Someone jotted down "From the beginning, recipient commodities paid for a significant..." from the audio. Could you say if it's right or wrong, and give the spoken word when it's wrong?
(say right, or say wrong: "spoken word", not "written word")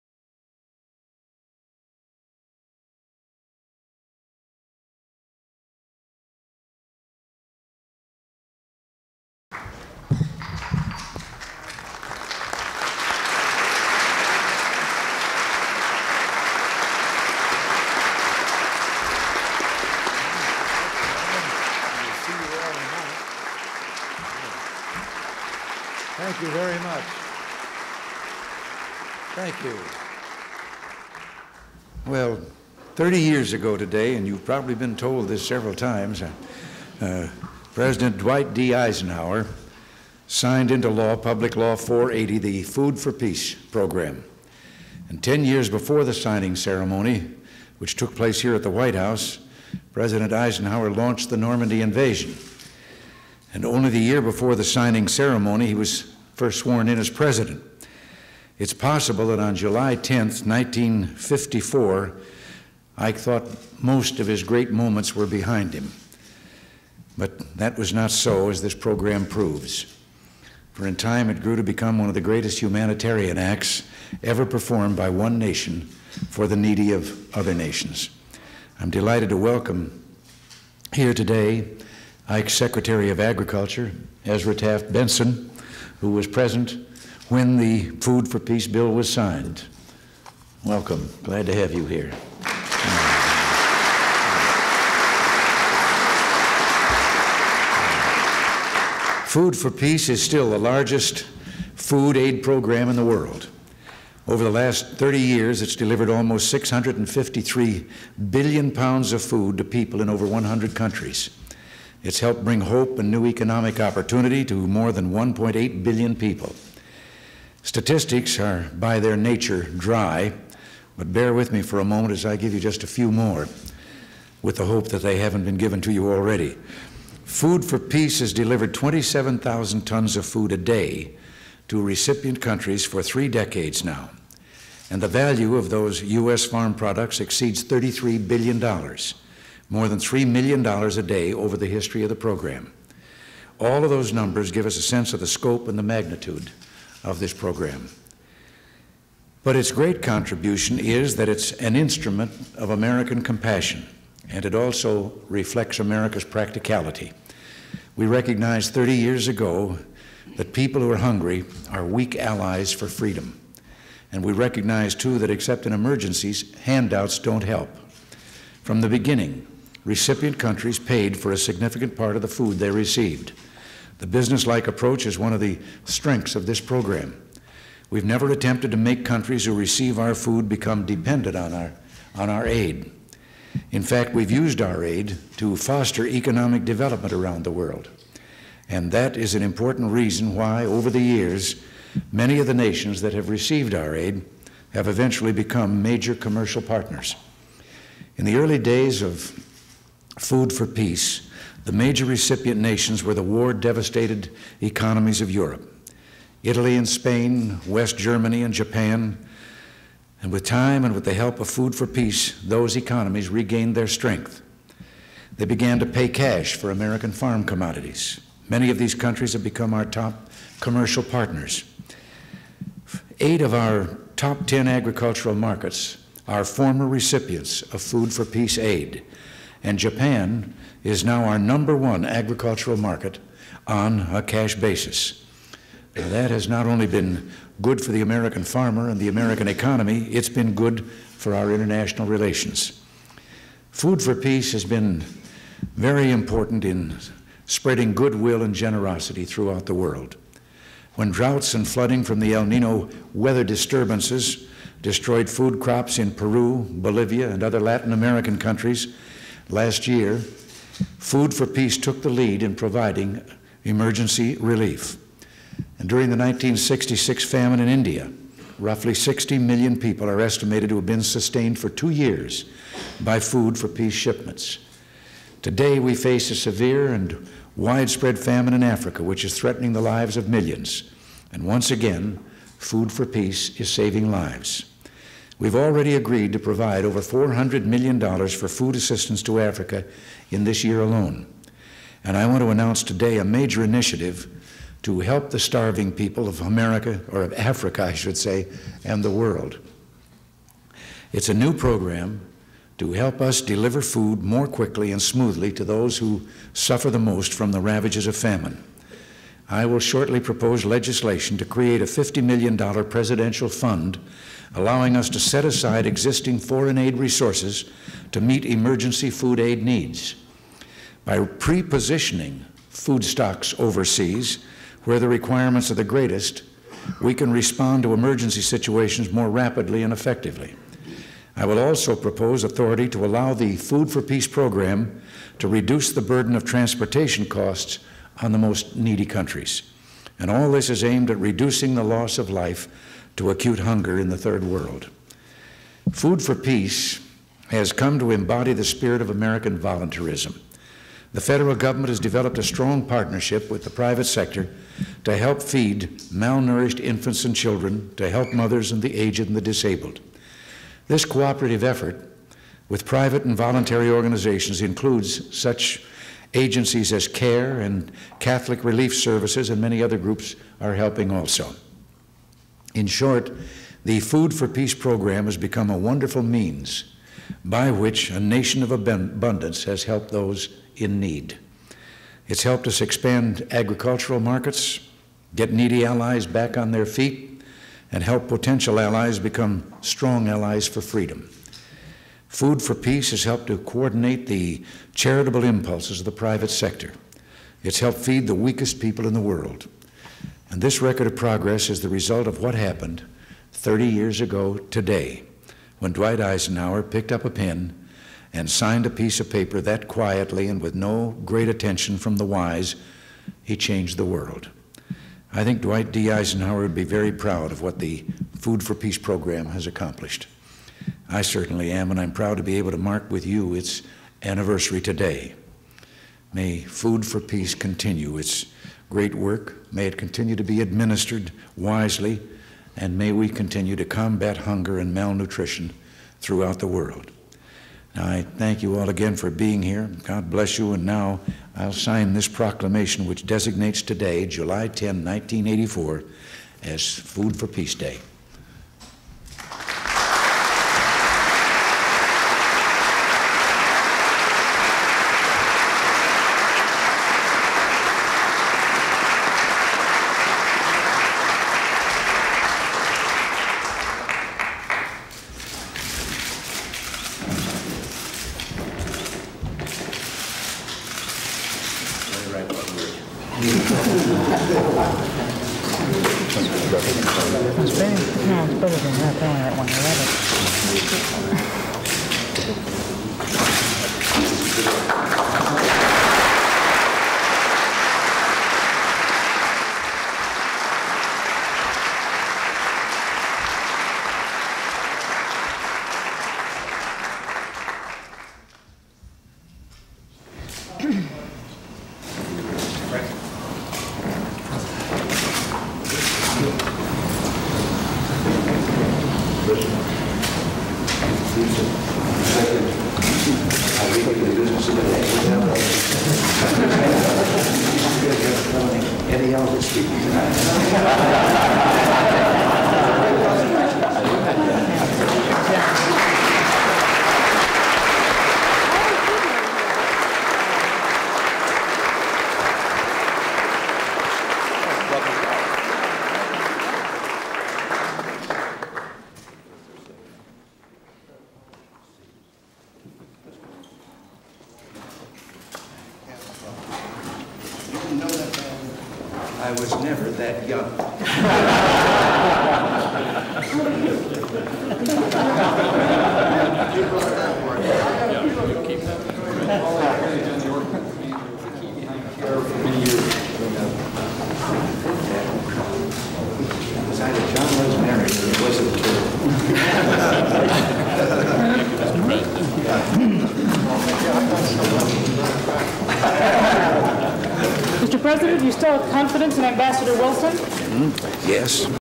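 wrong: "countries", not "commodities".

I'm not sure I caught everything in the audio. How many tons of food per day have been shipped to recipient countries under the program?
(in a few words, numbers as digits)
27,000.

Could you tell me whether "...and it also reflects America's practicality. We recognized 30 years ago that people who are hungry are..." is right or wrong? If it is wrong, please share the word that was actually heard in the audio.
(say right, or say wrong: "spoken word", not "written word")
right.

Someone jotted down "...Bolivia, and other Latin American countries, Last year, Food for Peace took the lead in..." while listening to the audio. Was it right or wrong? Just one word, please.
right.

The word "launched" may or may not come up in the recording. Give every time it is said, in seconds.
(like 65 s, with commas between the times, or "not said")
50 s.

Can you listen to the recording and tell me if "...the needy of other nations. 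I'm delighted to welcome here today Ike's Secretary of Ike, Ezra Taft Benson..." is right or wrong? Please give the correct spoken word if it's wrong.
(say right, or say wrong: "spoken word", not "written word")
wrong: "Agriculture", not "Ike".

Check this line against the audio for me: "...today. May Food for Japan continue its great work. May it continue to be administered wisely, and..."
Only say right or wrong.
wrong.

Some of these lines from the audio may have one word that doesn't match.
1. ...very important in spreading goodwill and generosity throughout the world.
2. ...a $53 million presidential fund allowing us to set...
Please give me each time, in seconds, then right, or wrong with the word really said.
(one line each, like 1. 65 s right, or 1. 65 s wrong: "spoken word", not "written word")
1. 245 s right
2. 311 s wrong: "50", not "53".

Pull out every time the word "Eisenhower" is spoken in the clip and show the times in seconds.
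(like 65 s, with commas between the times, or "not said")
38 s, 50 s, 406 s, 416 s.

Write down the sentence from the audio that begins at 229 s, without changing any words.
And Japan is now our number one agricultural market on a cash basis.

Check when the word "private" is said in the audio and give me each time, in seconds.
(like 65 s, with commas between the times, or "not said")
353 s, 362 s, 396 s.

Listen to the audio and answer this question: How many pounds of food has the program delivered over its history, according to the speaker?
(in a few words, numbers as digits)
653 billion.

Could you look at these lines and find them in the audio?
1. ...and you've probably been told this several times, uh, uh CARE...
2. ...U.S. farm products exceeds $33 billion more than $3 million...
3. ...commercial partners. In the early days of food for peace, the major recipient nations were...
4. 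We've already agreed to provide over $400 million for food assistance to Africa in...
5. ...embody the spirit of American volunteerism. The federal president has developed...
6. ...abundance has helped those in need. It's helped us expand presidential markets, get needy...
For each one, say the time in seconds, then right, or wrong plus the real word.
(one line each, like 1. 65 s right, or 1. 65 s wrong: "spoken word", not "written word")
1. 34 s wrong: "President", not "CARE"
2. 136 s right
3. 196 s right
4. 285 s right
5. 348 s wrong: "government", not "president"
6. 378 s wrong: "agricultural", not "presidential".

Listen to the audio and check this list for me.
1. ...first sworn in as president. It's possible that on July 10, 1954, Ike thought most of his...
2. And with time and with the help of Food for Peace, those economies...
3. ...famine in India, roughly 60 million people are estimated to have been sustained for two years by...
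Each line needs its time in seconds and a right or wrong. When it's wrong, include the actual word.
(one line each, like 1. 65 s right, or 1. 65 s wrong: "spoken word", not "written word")
1. 56 s right
2. 210 s right
3. 267 s right.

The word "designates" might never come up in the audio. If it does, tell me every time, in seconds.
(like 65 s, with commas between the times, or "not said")
443 s.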